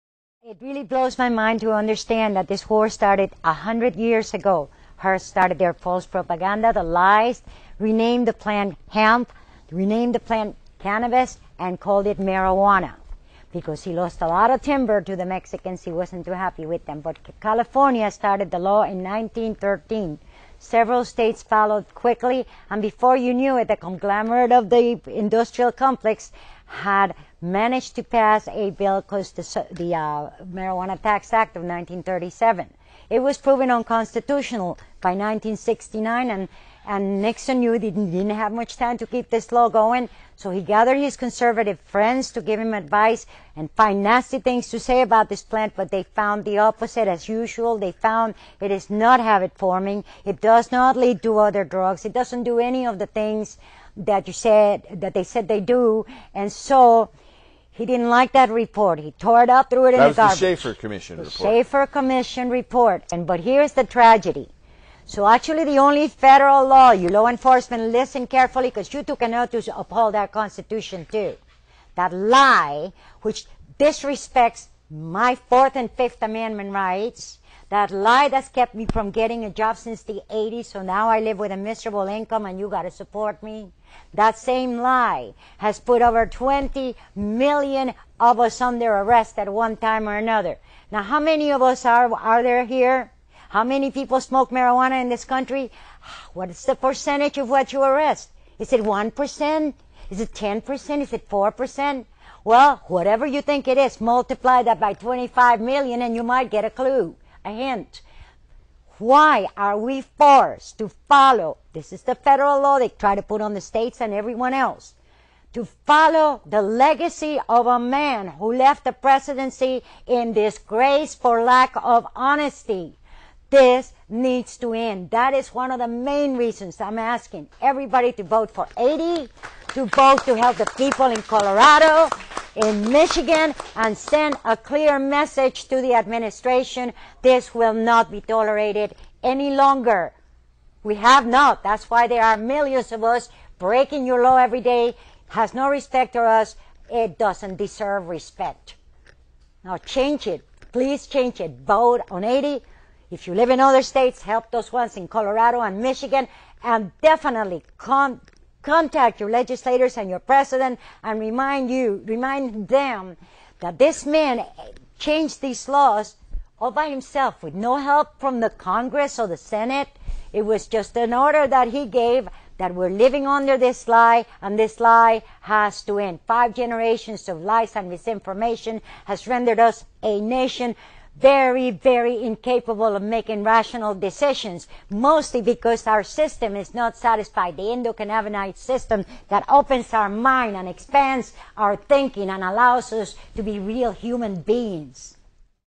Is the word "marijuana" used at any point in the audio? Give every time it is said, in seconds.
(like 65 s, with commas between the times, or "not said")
12 s, 30 s, 94 s.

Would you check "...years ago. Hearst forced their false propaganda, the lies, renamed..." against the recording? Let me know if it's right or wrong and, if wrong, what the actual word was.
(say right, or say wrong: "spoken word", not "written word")
wrong: "started", not "forced".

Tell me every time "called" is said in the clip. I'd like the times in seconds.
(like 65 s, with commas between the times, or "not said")
11 s, 29 s.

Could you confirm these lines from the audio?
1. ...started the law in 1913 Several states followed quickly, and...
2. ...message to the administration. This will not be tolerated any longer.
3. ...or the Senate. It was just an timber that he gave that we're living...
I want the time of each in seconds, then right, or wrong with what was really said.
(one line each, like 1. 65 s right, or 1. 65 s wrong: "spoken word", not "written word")
1. 18 s right
2. 134 s right
3. 169 s wrong: "order", not "timber".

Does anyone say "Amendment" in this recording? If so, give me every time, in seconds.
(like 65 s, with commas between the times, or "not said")
76 s.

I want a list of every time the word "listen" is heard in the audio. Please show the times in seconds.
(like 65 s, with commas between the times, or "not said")
67 s.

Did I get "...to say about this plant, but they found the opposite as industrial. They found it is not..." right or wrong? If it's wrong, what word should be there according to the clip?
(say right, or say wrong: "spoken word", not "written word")
wrong: "usual", not "industrial".